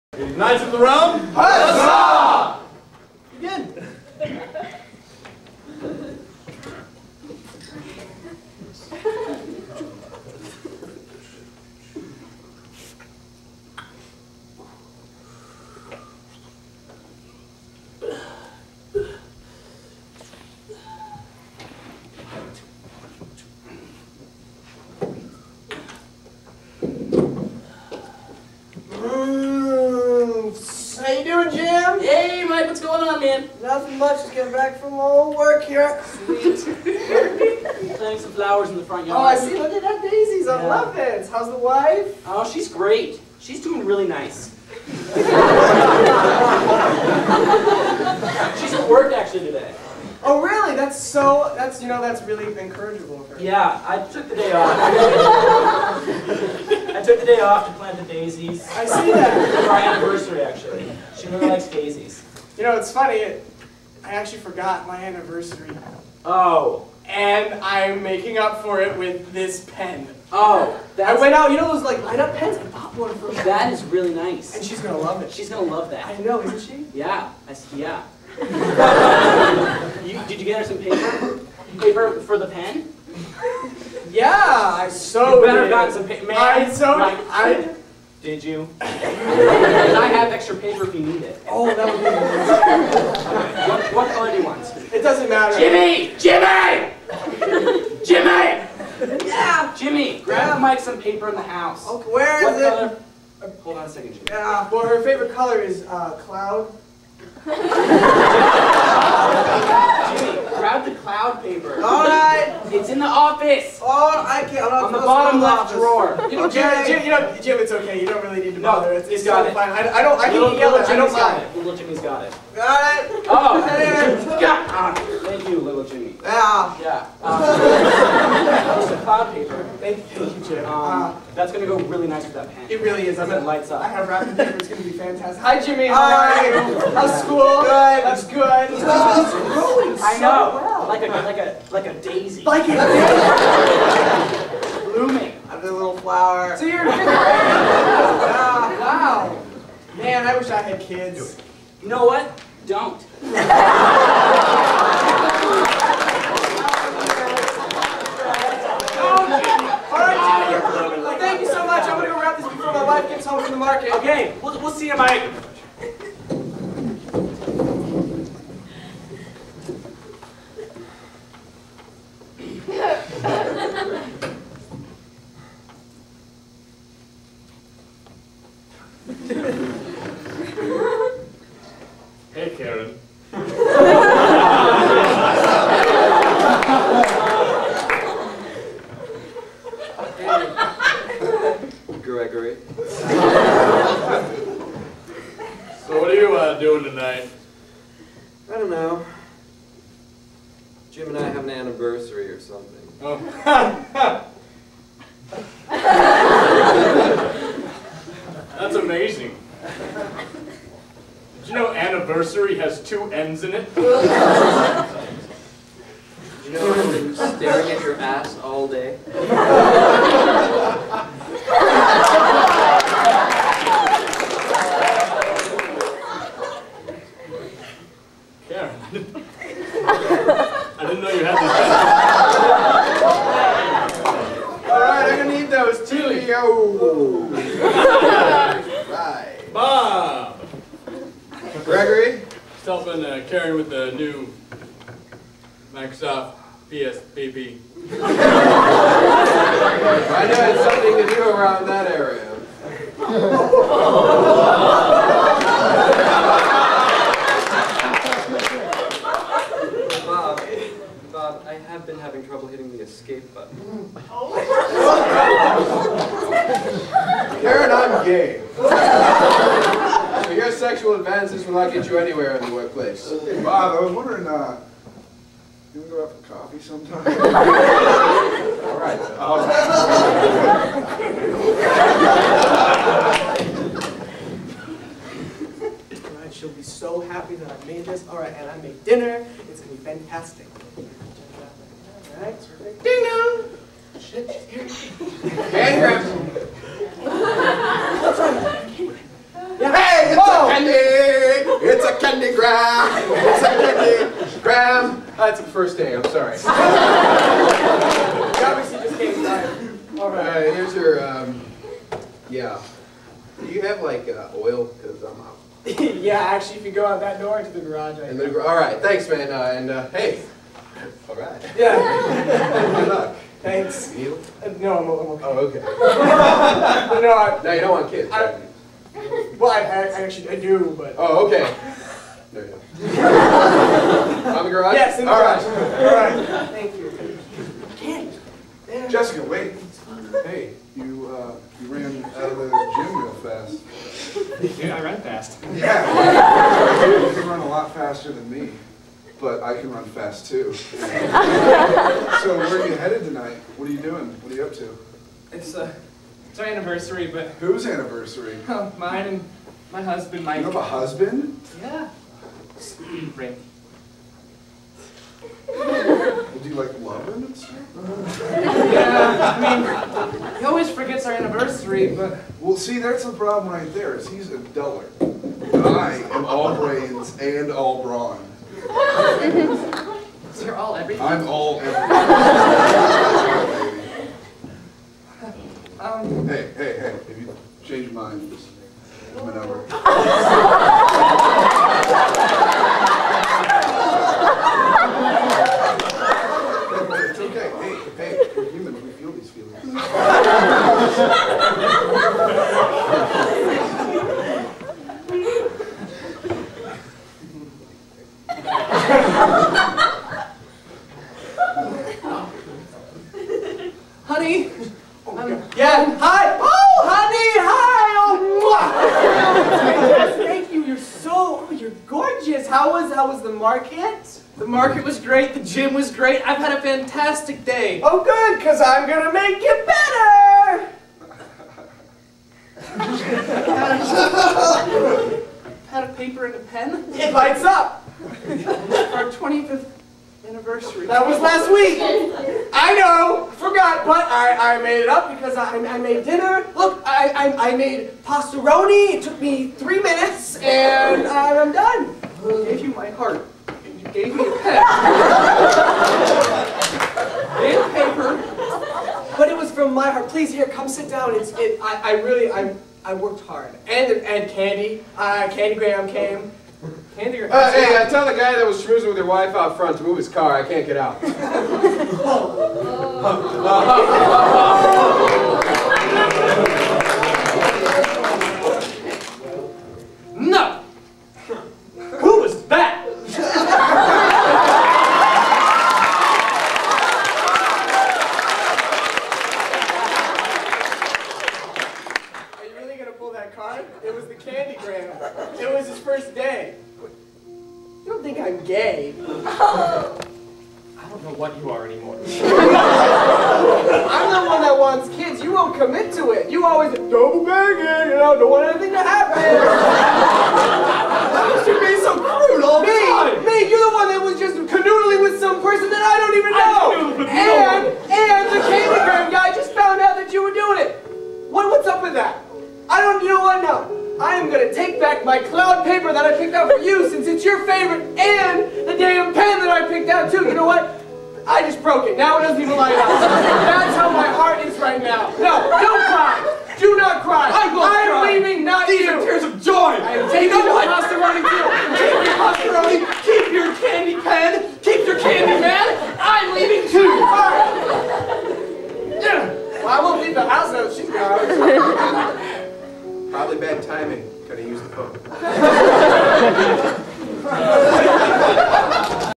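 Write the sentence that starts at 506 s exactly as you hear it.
You always double banging, you know, don't want anything to happen.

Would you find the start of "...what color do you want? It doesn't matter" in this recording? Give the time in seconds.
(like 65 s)
93 s.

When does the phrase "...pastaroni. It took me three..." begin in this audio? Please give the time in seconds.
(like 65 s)
448 s.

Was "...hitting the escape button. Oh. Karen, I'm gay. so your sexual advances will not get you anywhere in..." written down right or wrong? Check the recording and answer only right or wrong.
right.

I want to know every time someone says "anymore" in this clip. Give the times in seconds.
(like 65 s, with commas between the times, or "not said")
501 s.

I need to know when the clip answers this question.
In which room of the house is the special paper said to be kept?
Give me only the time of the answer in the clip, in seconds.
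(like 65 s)
112 s.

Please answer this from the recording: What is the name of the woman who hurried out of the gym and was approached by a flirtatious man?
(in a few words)
Jessica.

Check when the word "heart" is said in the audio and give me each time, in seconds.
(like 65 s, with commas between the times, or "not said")
452 s, 459 s, 534 s.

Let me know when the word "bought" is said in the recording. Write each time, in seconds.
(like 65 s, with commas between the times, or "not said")
72 s.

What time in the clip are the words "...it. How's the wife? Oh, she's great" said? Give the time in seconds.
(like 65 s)
40 s.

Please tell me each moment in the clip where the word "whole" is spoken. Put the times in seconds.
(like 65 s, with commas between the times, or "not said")
not said.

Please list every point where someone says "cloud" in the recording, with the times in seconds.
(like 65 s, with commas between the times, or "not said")
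106 s, 110 s, 129 s, 525 s.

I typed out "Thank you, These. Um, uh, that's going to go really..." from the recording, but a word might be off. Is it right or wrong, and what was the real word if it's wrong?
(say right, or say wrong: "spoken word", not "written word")
wrong: "Jim", not "These".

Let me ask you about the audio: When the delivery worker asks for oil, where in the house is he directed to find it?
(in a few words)
The garage.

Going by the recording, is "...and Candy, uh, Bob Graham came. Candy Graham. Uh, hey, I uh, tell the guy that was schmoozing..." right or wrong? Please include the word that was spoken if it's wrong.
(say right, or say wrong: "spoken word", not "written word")
wrong: "Candy", not "Bob".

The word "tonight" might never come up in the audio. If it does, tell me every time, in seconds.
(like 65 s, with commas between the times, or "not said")
196 s, 353 s.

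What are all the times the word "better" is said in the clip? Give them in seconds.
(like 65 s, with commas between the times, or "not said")
85 s, 429 s.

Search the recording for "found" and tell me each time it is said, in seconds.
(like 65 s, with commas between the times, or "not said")
519 s.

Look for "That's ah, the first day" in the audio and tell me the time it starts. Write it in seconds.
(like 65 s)
305 s.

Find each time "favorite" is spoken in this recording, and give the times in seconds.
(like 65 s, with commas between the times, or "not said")
105 s, 527 s.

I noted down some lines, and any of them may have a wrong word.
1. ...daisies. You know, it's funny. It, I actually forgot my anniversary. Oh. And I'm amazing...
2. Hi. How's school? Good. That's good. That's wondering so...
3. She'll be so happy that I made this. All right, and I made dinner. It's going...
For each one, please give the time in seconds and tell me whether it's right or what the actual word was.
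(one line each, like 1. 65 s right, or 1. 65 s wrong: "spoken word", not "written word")
1. 61 s wrong: "making", not "amazing"
2. 135 s wrong: "growing", not "wondering"
3. 286 s right.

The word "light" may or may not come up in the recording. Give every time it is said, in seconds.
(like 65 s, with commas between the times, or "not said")
72 s, 133 s, 437 s, 532 s.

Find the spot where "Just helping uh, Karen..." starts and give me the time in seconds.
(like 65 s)
242 s.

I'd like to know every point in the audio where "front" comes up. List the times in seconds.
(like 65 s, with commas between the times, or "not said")
38 s, 469 s.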